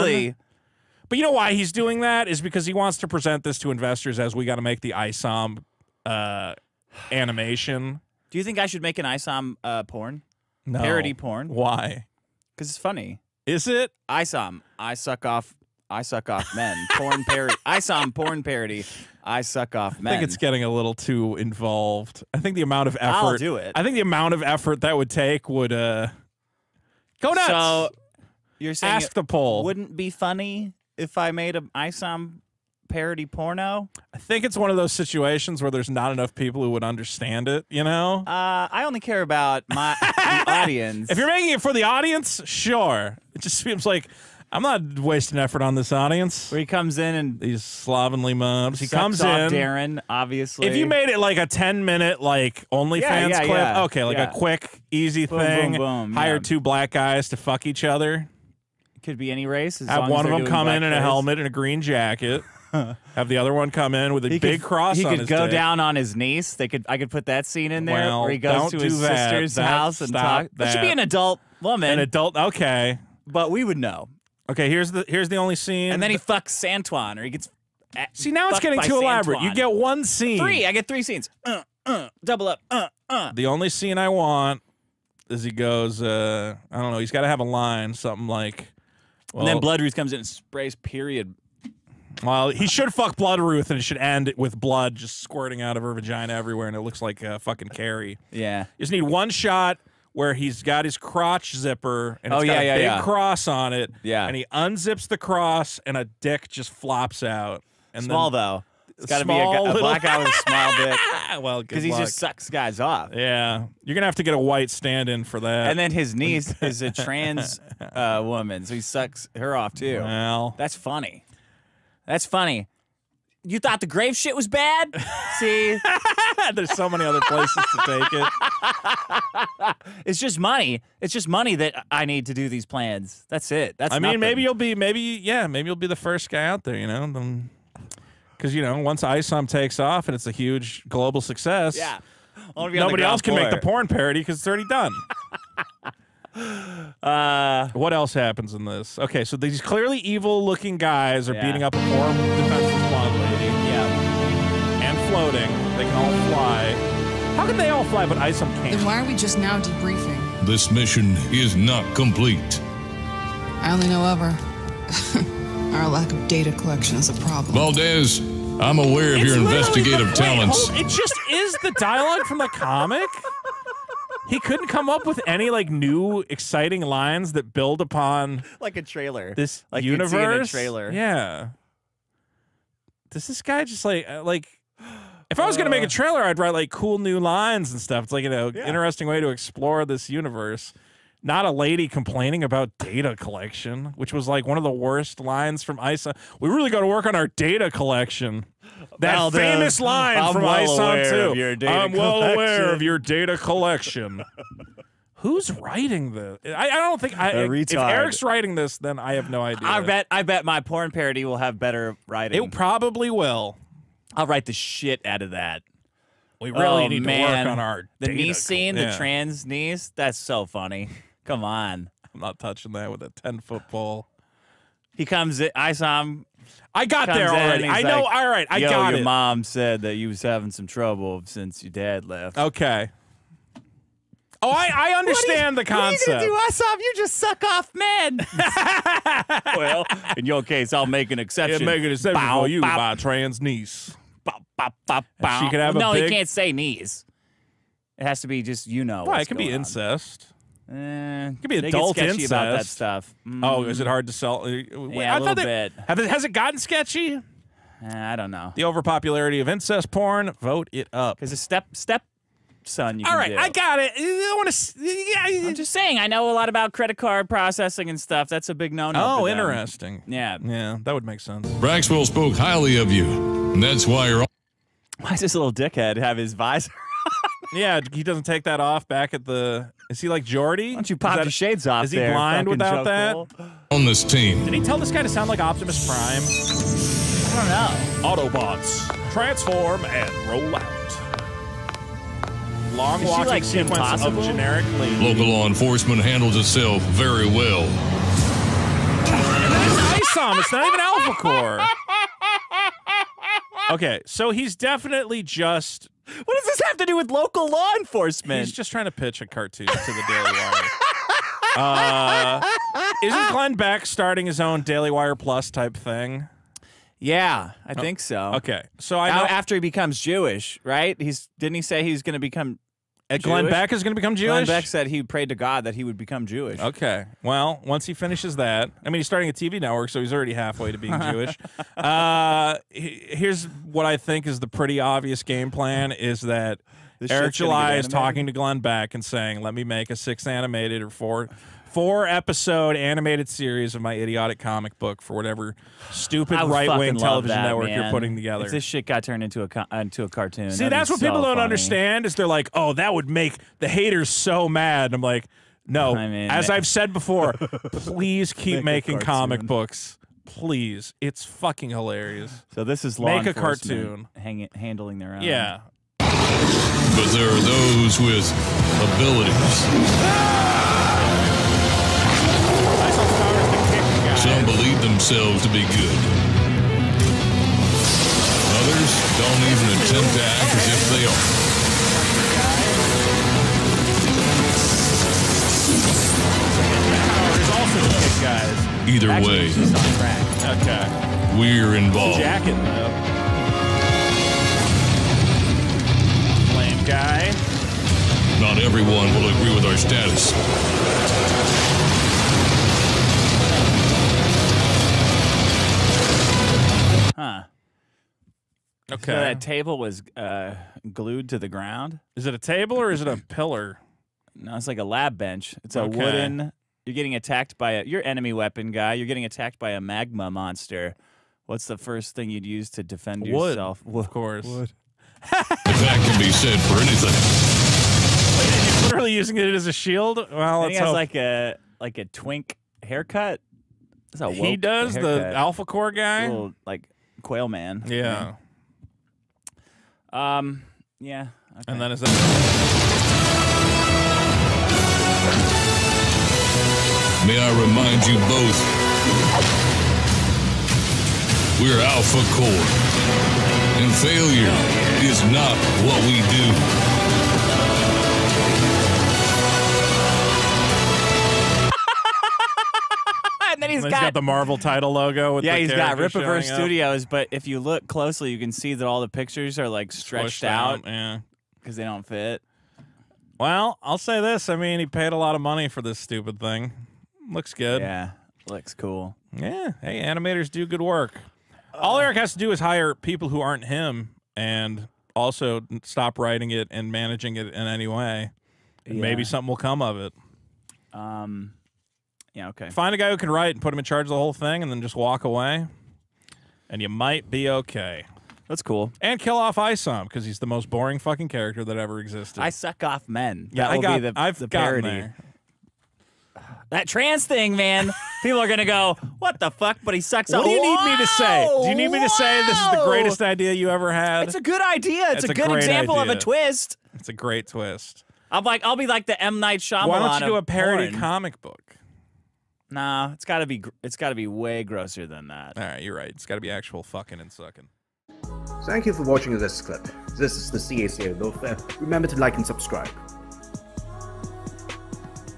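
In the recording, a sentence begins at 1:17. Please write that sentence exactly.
Uh, See now it's getting too Santuan.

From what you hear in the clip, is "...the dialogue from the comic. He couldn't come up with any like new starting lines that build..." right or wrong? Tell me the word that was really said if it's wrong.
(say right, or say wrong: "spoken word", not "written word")
wrong: "exciting", not "starting".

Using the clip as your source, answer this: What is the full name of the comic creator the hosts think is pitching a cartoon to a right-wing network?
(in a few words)
Eric July.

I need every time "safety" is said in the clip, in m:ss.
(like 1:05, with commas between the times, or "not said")
not said.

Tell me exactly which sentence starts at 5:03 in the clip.
Okay, so he's definitely just what does this have to do with local law enforcement?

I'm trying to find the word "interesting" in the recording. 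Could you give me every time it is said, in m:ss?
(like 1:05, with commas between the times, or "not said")
3:08, 4:29.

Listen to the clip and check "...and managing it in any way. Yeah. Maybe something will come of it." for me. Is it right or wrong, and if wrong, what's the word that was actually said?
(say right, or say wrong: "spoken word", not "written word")
right.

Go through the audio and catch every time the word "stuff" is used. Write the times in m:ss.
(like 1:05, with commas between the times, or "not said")
3:07, 4:12, 4:28.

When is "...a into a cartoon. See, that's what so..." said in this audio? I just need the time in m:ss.
5:49.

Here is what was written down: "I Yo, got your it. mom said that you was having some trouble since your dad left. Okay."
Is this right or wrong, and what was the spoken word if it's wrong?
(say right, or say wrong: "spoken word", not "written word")
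right.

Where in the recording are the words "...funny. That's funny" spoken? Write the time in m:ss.
2:00.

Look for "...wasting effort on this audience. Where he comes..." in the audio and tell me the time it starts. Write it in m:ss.
0:44.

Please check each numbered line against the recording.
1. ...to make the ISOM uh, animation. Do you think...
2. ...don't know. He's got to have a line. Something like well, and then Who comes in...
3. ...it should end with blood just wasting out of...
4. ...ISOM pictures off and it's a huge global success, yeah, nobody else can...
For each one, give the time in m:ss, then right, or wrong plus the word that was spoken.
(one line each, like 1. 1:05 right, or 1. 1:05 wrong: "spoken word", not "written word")
1. 0:04 right
2. 1:26 wrong: "Bloodruth", not "Who"
3. 1:33 wrong: "squirting", not "wasting"
4. 2:19 wrong: "takes", not "pictures".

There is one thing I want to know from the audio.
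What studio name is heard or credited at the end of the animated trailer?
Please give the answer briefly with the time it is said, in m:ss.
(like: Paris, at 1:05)
Rippaverse Studios, at 7:45.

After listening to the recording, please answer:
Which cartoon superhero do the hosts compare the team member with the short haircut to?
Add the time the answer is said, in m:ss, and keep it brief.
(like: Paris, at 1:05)
Quail Man, at 7:17.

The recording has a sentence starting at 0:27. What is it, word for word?
So you're saying ask the poll wouldn't be funny if I made an ISOM parody porno?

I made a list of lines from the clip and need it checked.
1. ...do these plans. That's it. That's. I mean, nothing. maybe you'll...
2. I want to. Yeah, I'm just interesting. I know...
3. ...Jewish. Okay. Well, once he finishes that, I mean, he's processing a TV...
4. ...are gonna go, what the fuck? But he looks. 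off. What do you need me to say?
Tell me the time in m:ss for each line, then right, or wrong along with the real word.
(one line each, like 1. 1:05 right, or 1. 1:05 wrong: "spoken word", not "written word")
1. 2:12 right
2. 4:23 wrong: "saying", not "interesting"
3. 5:26 wrong: "starting", not "processing"
4. 8:28 wrong: "sucks", not "looks".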